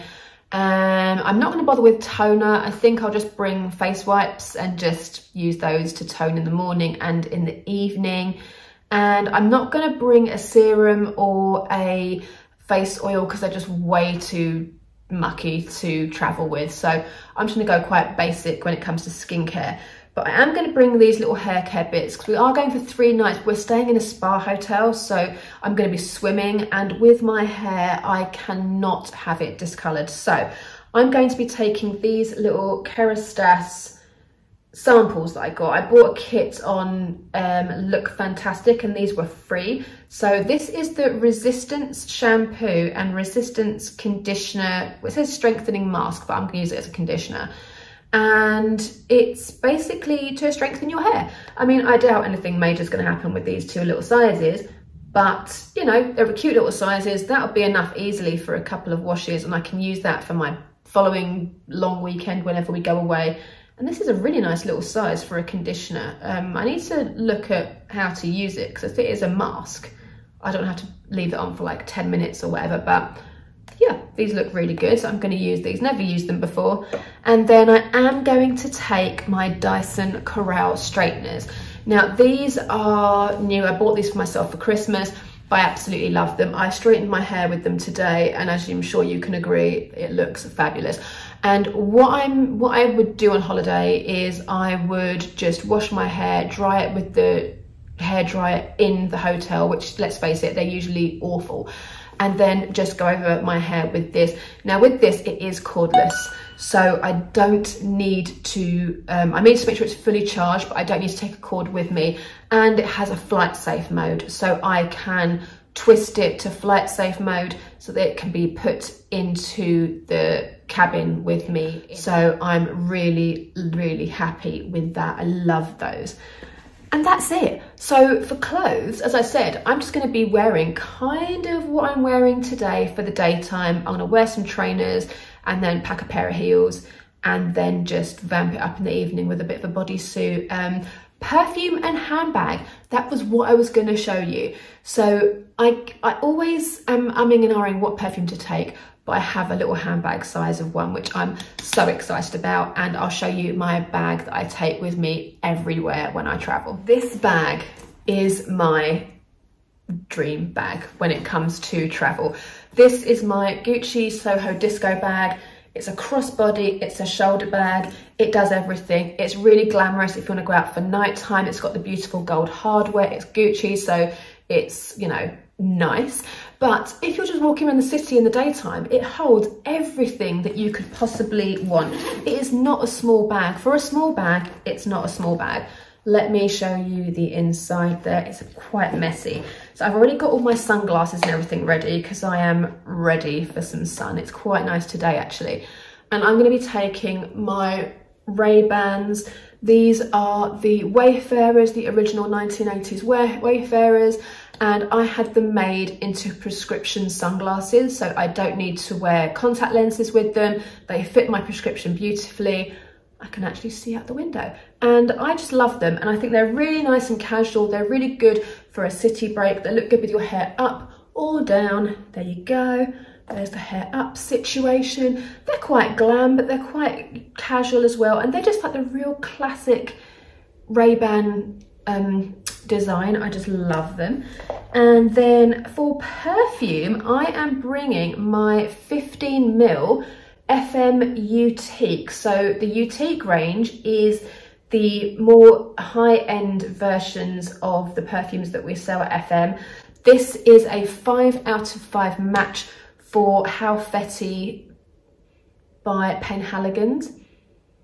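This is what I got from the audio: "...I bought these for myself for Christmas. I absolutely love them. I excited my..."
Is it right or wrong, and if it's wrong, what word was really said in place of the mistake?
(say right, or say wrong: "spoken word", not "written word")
wrong: "straightened", not "excited".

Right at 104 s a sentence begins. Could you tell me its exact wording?
Now with this, it is cordless.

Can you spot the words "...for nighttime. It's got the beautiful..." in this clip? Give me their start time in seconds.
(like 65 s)
170 s.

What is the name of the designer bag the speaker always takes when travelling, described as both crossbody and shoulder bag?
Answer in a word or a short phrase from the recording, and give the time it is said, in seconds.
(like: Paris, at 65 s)
Gucci Soho disco, at 163 s.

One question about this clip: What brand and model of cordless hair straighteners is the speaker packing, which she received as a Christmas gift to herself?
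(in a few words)
Dyson Corrale.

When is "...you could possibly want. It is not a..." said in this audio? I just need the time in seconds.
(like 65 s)
180 s.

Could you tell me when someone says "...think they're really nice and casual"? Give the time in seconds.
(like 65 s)
216 s.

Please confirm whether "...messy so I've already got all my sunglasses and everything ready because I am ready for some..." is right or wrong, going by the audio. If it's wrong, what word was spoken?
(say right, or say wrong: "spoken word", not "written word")
right.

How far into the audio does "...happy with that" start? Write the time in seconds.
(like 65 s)
124 s.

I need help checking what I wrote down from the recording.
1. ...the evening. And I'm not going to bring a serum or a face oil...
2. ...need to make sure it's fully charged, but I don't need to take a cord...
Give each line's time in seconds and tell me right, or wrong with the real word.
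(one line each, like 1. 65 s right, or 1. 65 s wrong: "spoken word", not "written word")
1. 7 s right
2. 109 s right.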